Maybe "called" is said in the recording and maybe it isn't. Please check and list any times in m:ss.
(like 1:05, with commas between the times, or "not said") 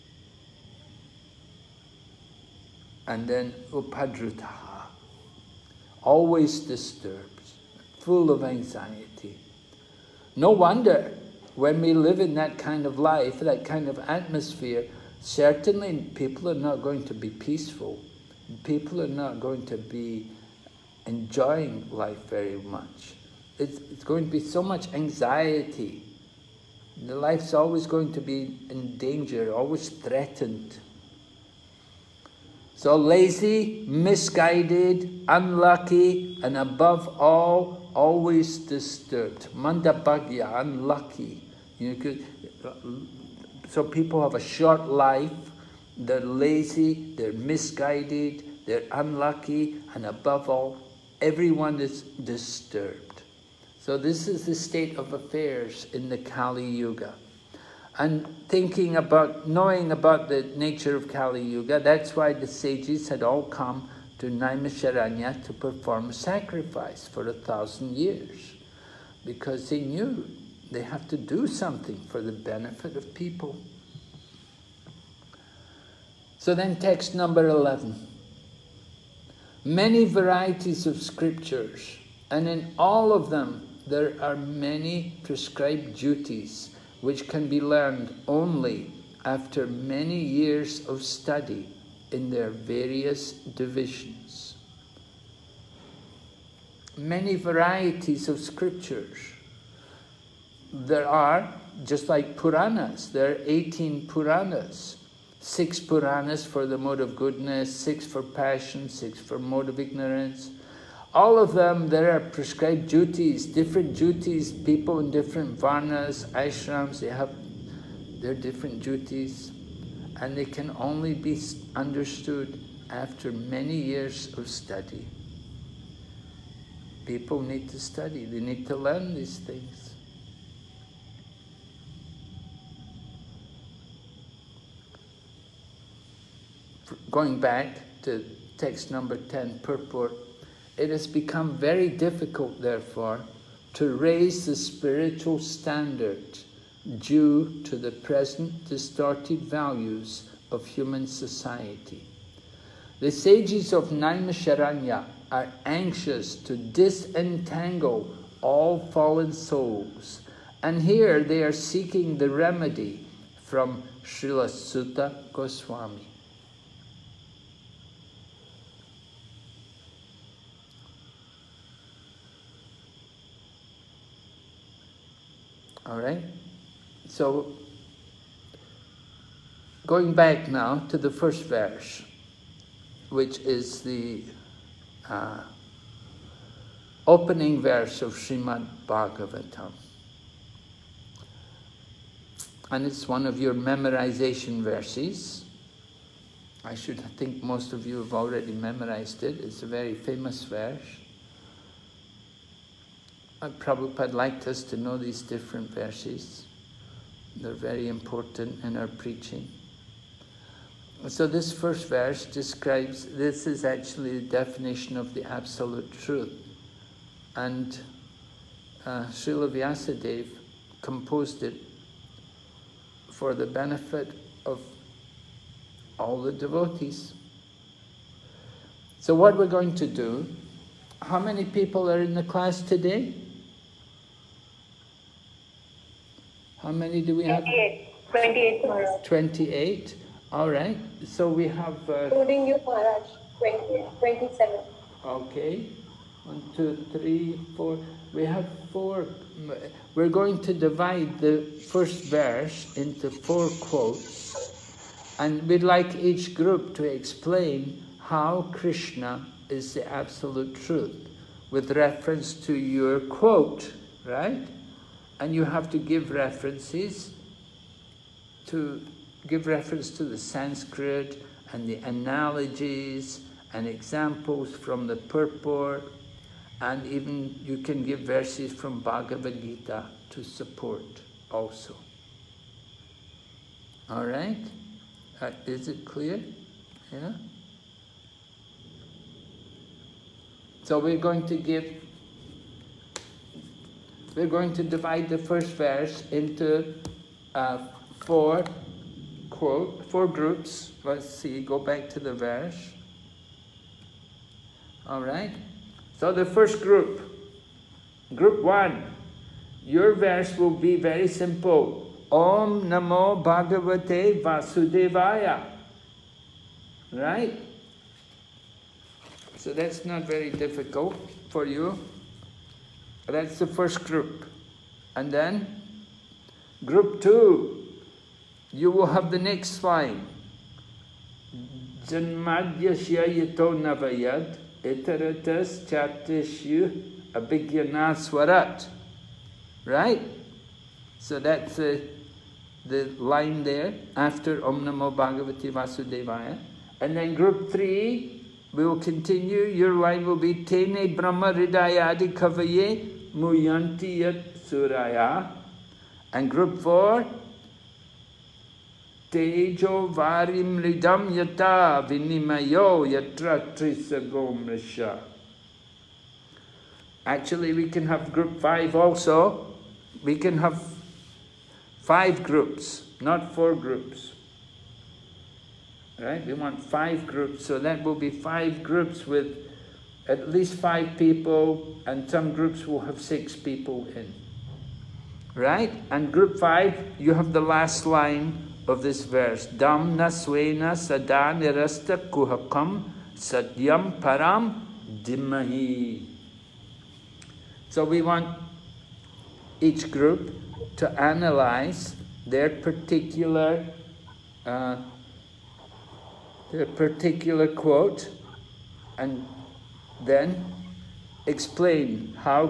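not said.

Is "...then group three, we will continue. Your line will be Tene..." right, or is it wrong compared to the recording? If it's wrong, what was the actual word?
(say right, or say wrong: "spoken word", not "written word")
right.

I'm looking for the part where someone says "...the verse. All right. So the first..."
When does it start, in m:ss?
5:01.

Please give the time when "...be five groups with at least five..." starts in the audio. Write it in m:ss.
6:17.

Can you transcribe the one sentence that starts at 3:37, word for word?
And uh, Srila Vyasadeva composed it for the benefit of all the devotees.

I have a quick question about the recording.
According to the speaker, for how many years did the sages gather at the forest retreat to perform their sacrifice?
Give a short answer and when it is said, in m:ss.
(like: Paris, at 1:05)
1000, at 1:07.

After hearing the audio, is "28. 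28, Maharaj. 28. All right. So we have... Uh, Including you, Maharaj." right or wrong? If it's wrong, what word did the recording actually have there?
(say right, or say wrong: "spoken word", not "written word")
right.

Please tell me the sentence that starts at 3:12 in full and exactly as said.
And it's one of your memorization verses.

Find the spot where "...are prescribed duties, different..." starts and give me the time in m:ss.
1:52.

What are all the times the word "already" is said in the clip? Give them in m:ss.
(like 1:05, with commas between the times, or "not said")
3:18.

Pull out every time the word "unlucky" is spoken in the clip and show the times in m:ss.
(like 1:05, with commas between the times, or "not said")
0:35, 0:40, 0:48.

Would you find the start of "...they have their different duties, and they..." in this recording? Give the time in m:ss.
1:56.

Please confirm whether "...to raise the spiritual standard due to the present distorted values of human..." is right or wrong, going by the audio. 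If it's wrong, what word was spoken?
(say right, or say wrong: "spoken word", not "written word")
right.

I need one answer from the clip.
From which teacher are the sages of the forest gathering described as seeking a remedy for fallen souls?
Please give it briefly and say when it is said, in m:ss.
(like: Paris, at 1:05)
Srila Suta Goswami, at 2:44.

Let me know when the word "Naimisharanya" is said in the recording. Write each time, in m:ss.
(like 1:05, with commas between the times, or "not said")
1:04, 2:33.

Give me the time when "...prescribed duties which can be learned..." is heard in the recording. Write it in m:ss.
1:25.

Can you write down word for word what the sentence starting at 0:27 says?
The life's always going to be in danger, always threatened.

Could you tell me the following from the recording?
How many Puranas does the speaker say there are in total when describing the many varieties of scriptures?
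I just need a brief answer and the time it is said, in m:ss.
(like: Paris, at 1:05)
18, at 1:43.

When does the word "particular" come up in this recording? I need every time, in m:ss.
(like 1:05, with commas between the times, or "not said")
6:42, 6:46.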